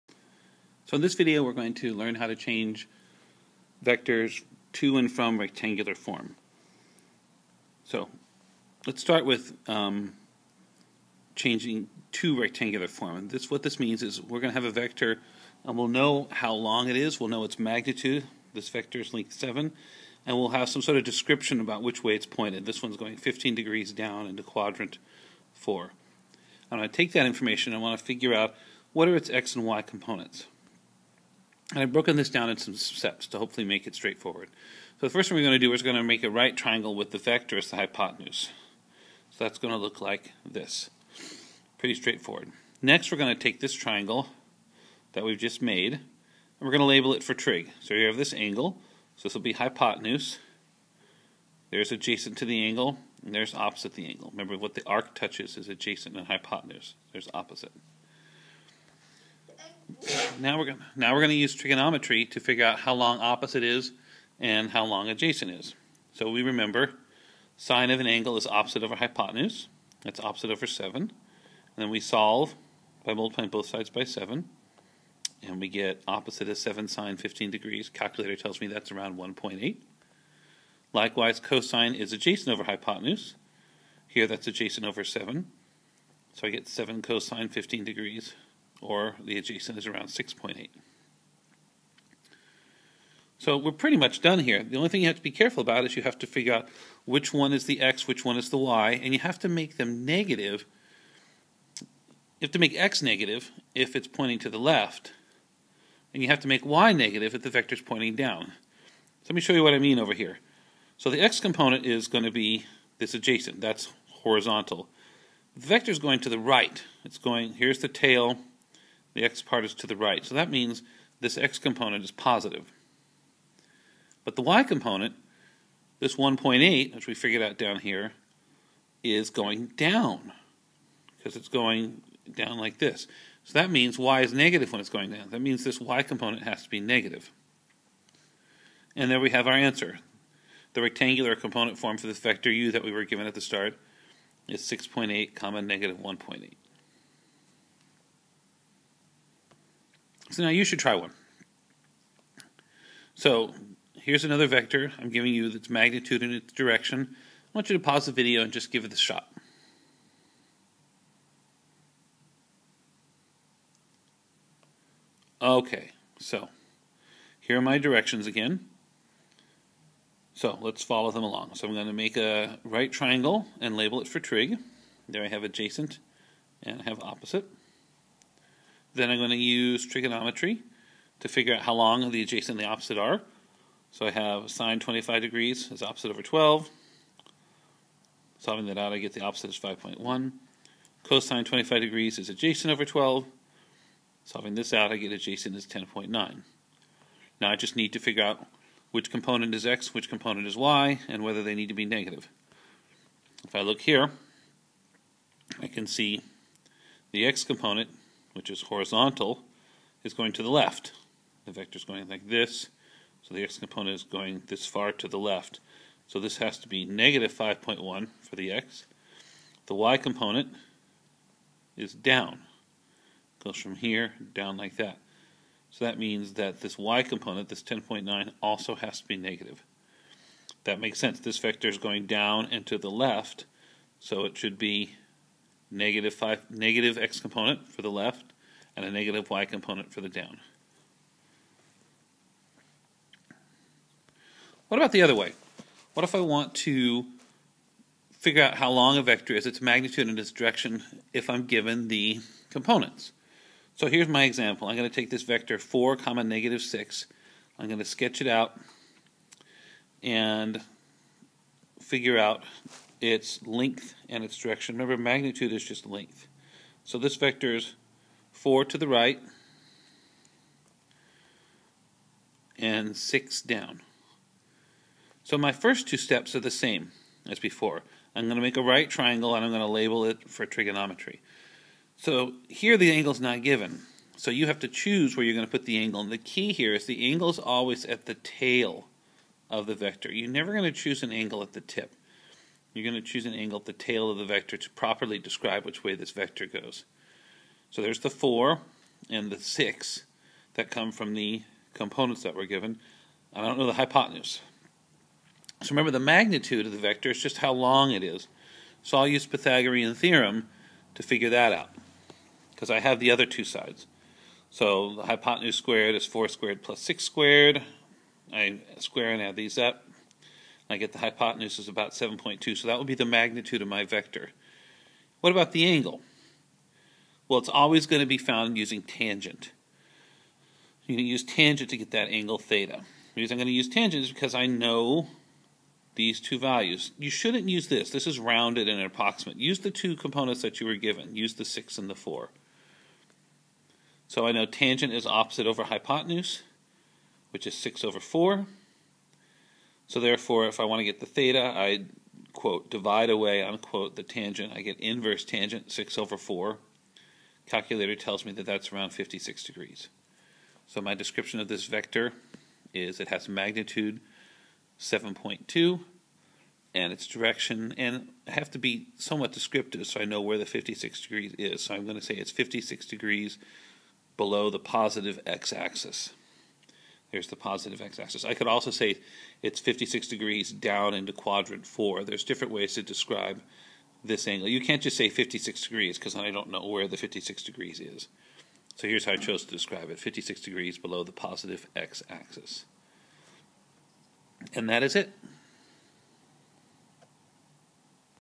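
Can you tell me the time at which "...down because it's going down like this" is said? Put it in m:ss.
2:09.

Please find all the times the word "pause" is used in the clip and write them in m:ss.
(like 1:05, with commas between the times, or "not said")
2:37.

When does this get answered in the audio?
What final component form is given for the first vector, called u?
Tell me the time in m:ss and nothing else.
2:24.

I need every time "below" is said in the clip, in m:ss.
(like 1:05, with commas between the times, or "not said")
6:14, 6:30.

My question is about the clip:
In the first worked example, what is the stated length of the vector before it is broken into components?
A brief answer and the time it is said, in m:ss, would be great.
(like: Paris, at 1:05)
7, at 0:19.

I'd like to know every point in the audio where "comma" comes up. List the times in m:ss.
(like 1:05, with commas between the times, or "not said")
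2:25, 4:15.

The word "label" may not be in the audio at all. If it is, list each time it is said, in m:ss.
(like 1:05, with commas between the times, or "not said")
0:46, 2:53, 4:39.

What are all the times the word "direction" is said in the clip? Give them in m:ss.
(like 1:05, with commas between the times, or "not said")
2:36, 2:47, 4:10, 4:24, 6:07.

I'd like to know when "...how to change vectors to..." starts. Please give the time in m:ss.
0:02.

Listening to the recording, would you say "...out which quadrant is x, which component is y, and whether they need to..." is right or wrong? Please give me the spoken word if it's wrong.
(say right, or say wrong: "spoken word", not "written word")
wrong: "component", not "quadrant".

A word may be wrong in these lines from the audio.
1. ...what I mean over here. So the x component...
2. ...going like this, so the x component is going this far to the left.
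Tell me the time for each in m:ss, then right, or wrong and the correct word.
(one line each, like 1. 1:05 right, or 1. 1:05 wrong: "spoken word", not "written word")
1. 1:49 right
2. 3:31 right.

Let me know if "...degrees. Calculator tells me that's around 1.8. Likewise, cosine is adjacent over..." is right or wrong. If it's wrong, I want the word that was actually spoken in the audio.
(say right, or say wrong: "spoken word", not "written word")
right.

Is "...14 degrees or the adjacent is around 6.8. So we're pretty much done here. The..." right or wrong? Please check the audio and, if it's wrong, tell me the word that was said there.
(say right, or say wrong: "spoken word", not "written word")
wrong: "15", not "14".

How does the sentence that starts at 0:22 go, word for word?
This one's going 15 degrees down into quadrant 4.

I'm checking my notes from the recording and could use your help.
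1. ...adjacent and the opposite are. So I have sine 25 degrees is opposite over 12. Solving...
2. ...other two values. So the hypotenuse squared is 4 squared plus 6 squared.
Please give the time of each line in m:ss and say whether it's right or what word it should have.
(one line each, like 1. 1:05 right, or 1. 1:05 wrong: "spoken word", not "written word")
1. 3:02 right
2. 5:13 wrong: "sides", not "values".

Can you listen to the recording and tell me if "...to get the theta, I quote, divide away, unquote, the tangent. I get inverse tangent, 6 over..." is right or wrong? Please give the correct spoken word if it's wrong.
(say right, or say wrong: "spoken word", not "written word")
right.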